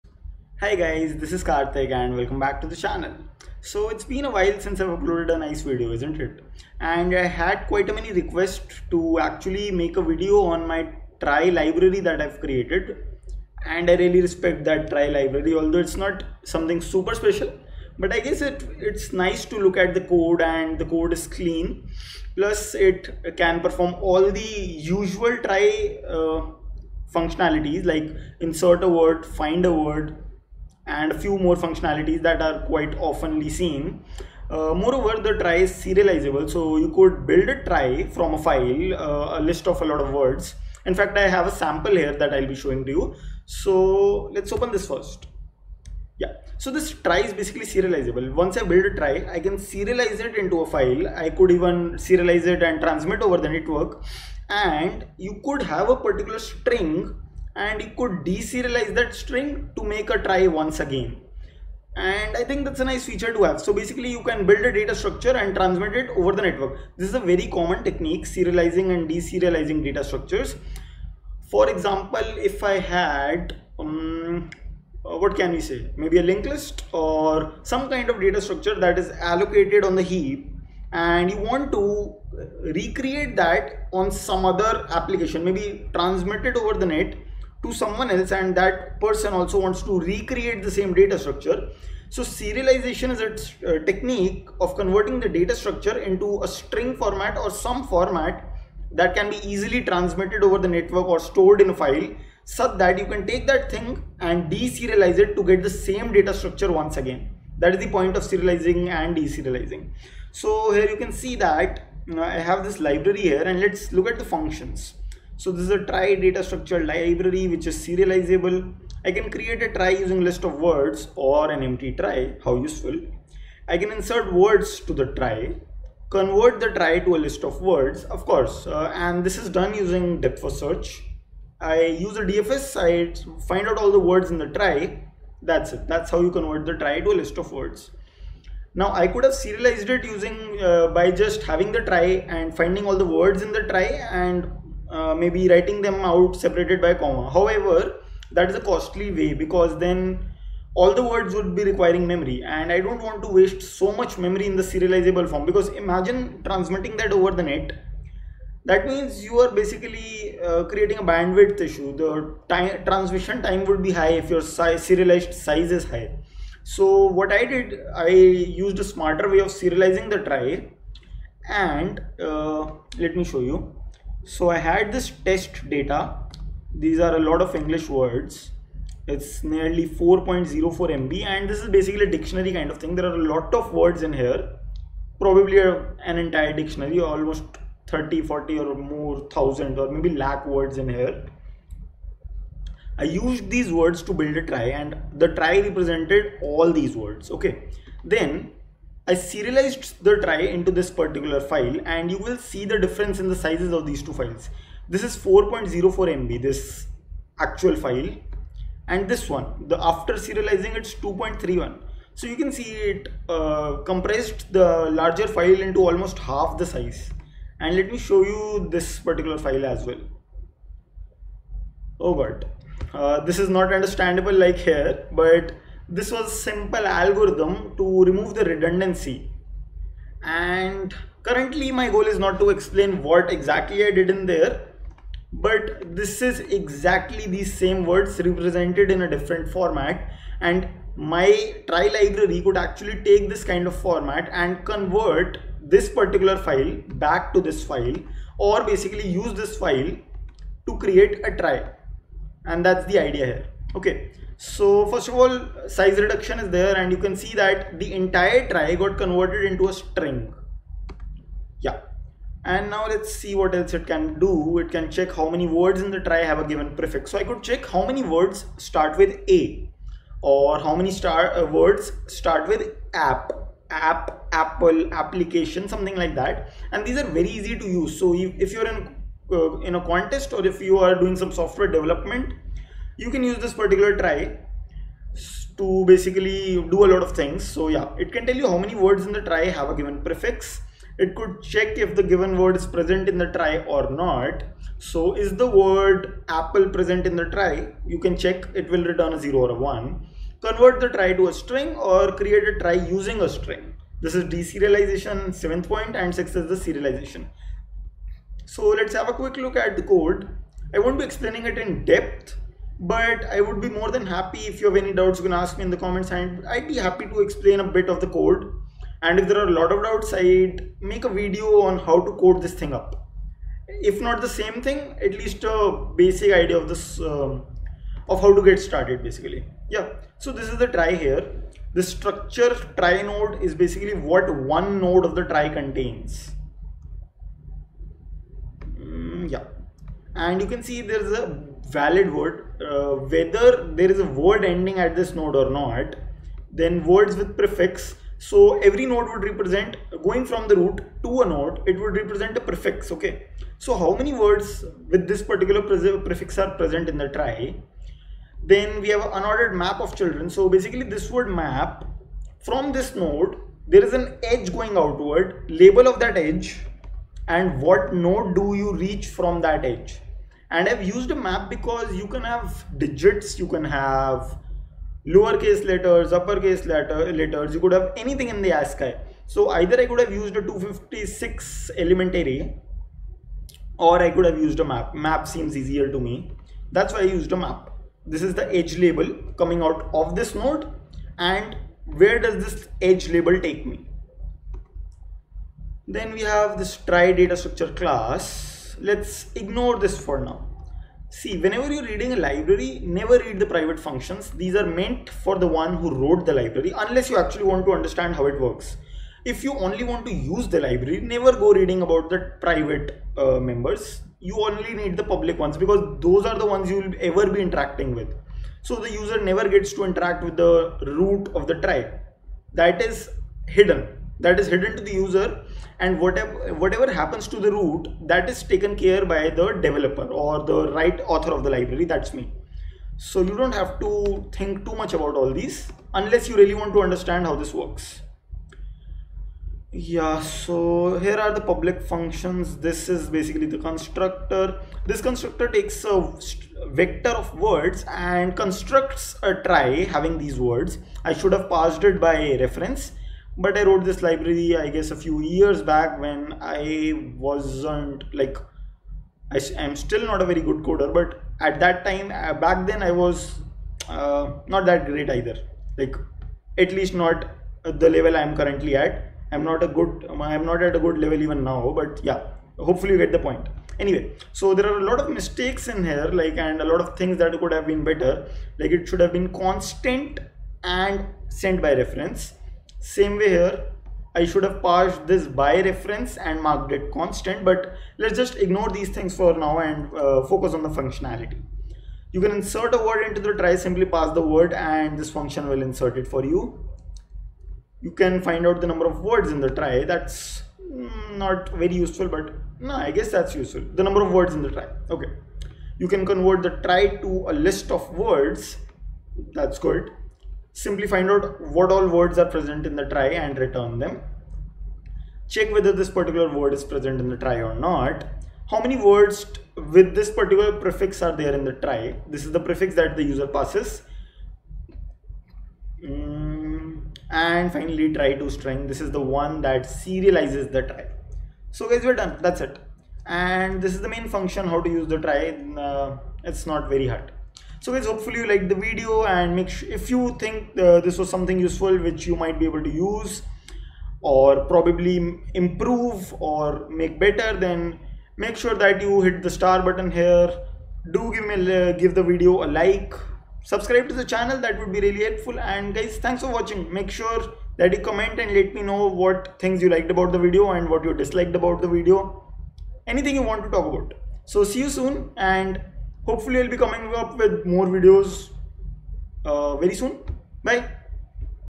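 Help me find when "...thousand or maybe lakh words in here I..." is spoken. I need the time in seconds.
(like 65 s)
189 s.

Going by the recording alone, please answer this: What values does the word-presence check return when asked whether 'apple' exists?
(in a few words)
0 or 1.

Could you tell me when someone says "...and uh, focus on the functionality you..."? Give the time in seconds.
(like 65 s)
489 s.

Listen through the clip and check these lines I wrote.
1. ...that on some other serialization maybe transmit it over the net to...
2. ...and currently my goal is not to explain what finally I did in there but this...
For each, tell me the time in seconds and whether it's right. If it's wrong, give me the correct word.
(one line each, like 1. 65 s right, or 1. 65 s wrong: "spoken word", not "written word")
1. 83 s wrong: "application", not "serialization"
2. 230 s wrong: "exactly", not "finally".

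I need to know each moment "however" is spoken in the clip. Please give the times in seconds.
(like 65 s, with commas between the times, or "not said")
147 s.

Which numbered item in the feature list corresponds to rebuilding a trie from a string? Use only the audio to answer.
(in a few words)
Seventh.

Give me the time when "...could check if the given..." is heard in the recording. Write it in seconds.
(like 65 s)
291 s.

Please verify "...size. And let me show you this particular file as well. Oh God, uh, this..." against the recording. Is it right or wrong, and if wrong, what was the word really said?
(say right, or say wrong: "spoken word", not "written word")
right.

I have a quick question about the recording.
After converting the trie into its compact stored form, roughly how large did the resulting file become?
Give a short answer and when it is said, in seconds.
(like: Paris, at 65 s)
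2.31 MB, at 210 s.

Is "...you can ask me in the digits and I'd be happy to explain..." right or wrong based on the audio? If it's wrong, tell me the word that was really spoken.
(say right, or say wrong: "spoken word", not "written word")
wrong: "comments", not "digits".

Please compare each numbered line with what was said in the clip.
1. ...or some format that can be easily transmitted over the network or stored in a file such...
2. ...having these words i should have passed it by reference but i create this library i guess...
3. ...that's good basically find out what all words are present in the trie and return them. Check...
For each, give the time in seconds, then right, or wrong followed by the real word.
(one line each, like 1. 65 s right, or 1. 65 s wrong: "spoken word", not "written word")
1. 97 s right
2. 449 s wrong: "wrote", not "create"
3. 509 s wrong: "simply", not "basically".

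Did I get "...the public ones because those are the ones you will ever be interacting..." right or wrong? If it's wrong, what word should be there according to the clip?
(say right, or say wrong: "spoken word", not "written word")
right.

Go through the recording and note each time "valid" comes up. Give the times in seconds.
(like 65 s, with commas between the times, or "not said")
341 s.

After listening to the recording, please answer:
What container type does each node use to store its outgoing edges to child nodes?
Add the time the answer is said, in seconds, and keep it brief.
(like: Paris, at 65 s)
Unordered map, at 359 s.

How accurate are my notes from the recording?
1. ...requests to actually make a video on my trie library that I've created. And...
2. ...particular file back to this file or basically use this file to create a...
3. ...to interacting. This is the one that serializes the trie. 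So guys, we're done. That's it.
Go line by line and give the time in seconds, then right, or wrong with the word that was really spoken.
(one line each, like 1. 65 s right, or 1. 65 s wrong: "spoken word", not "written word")
1. 8 s right
2. 245 s right
3. 528 s wrong: "string", not "interacting".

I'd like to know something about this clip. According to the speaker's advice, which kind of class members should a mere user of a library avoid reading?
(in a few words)
Private functions.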